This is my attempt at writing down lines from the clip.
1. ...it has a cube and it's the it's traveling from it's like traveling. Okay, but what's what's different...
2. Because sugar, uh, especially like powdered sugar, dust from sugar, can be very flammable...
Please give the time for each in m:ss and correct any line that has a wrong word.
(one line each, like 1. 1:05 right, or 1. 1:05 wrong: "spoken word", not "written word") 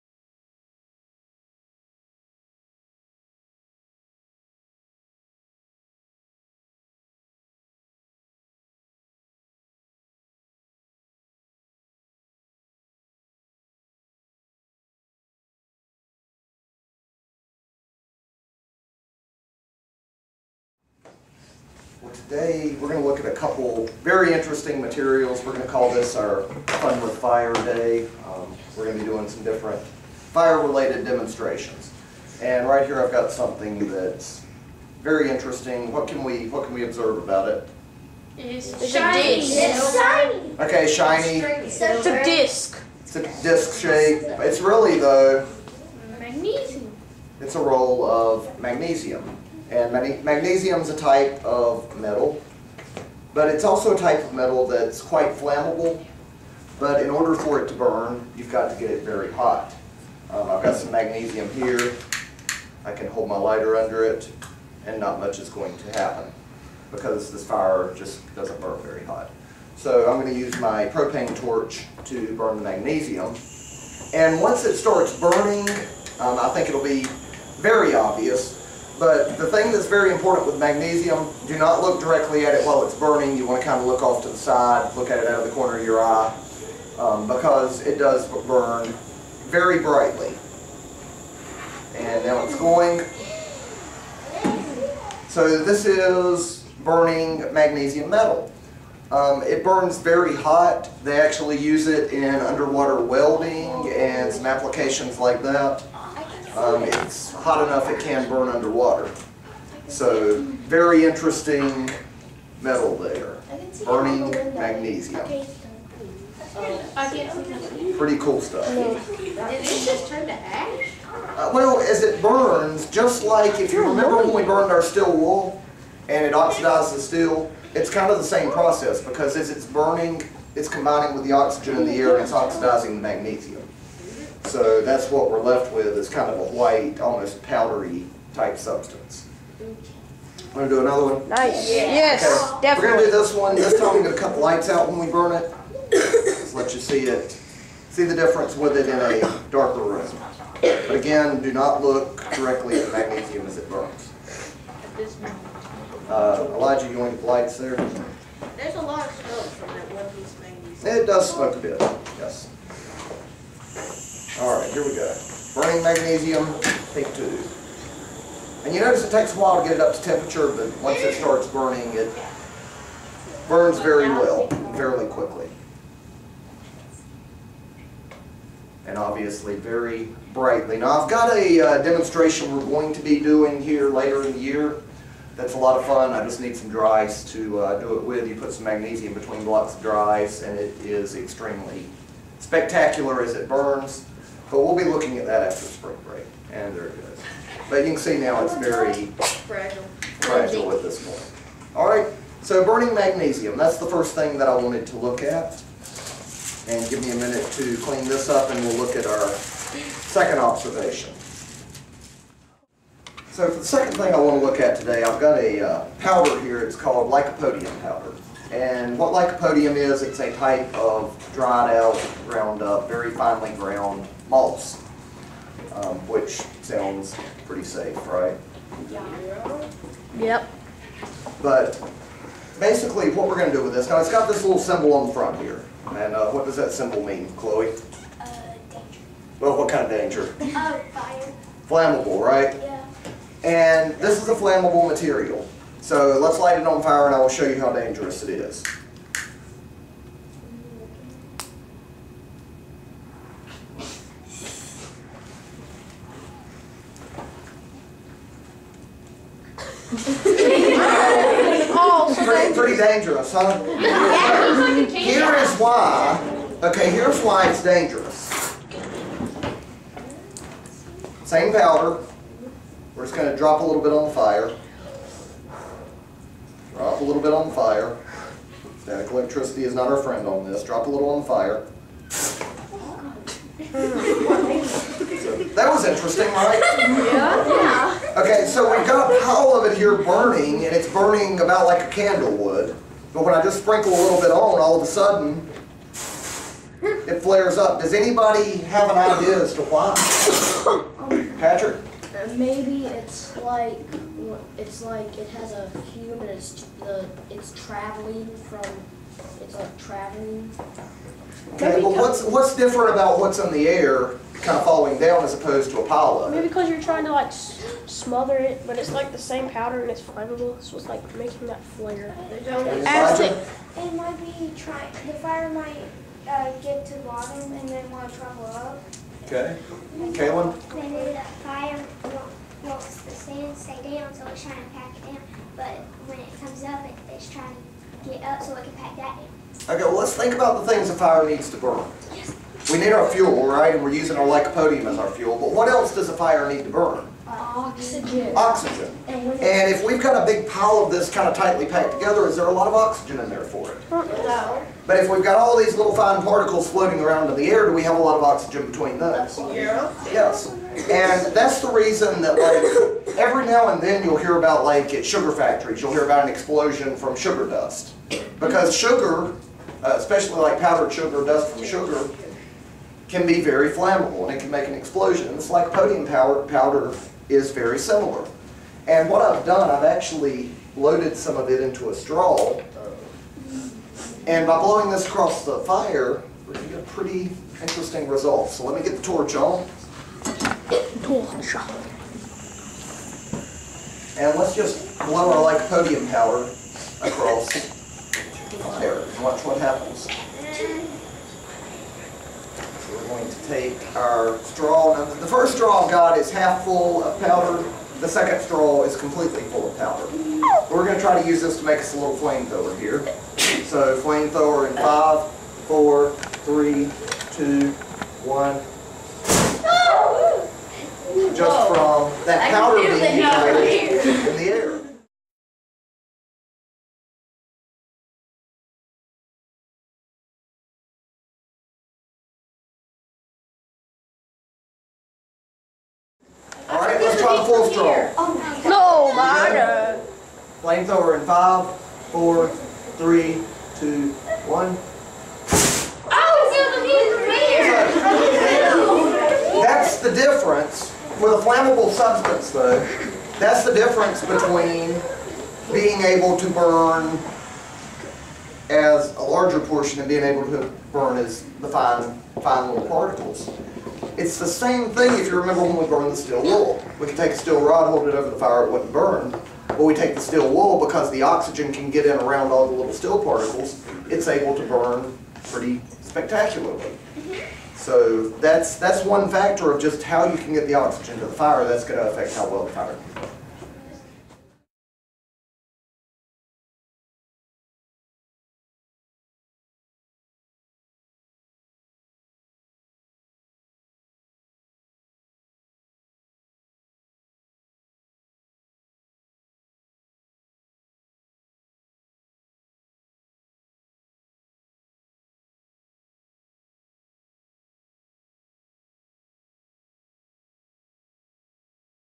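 1. 5:05 right
2. 6:08 right.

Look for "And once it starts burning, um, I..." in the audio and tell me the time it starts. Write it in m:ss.
1:14.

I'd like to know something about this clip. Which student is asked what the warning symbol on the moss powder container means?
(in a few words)
Chloe.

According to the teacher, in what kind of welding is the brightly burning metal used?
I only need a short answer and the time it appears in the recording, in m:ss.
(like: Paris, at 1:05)
underwater welding, at 1:42.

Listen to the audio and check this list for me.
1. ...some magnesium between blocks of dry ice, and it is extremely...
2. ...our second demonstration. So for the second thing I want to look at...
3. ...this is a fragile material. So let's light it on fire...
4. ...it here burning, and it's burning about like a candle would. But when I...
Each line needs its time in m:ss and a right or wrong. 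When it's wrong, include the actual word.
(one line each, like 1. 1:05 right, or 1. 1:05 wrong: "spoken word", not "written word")
1. 3:08 right
2. 3:29 wrong: "observation", not "demonstration"
3. 4:03 wrong: "flammable", not "fragile"
4. 4:49 right.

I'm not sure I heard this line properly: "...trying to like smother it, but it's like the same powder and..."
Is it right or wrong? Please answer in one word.
right.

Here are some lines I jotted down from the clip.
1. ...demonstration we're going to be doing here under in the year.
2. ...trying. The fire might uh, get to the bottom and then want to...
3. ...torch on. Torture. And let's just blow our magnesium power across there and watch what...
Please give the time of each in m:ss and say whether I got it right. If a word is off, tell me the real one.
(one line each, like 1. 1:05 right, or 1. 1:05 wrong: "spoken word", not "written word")
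1. 3:01 wrong: "later", not "under"
2. 5:24 right
3. 6:29 wrong: "podium", not "magnesium".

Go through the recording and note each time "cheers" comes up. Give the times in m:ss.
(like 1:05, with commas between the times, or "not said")
not said.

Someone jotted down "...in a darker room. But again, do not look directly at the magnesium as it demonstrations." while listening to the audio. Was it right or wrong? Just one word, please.
wrong.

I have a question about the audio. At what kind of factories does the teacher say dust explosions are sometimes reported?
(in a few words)
sugar factories.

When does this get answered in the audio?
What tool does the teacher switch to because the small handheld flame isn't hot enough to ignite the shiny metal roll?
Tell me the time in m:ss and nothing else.
1:10.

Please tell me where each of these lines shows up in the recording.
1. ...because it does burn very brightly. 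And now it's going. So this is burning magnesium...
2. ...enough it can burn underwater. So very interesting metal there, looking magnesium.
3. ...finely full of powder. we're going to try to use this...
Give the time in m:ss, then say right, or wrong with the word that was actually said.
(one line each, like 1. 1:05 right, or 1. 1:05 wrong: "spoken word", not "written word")
1. 1:27 right
2. 1:47 wrong: "burning", not "looking"
3. 6:48 wrong: "completely", not "finely".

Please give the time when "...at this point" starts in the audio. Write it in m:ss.
3:20.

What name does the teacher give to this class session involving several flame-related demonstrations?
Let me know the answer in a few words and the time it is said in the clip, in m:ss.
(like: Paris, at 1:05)
Fun with Fire Day, at 0:26.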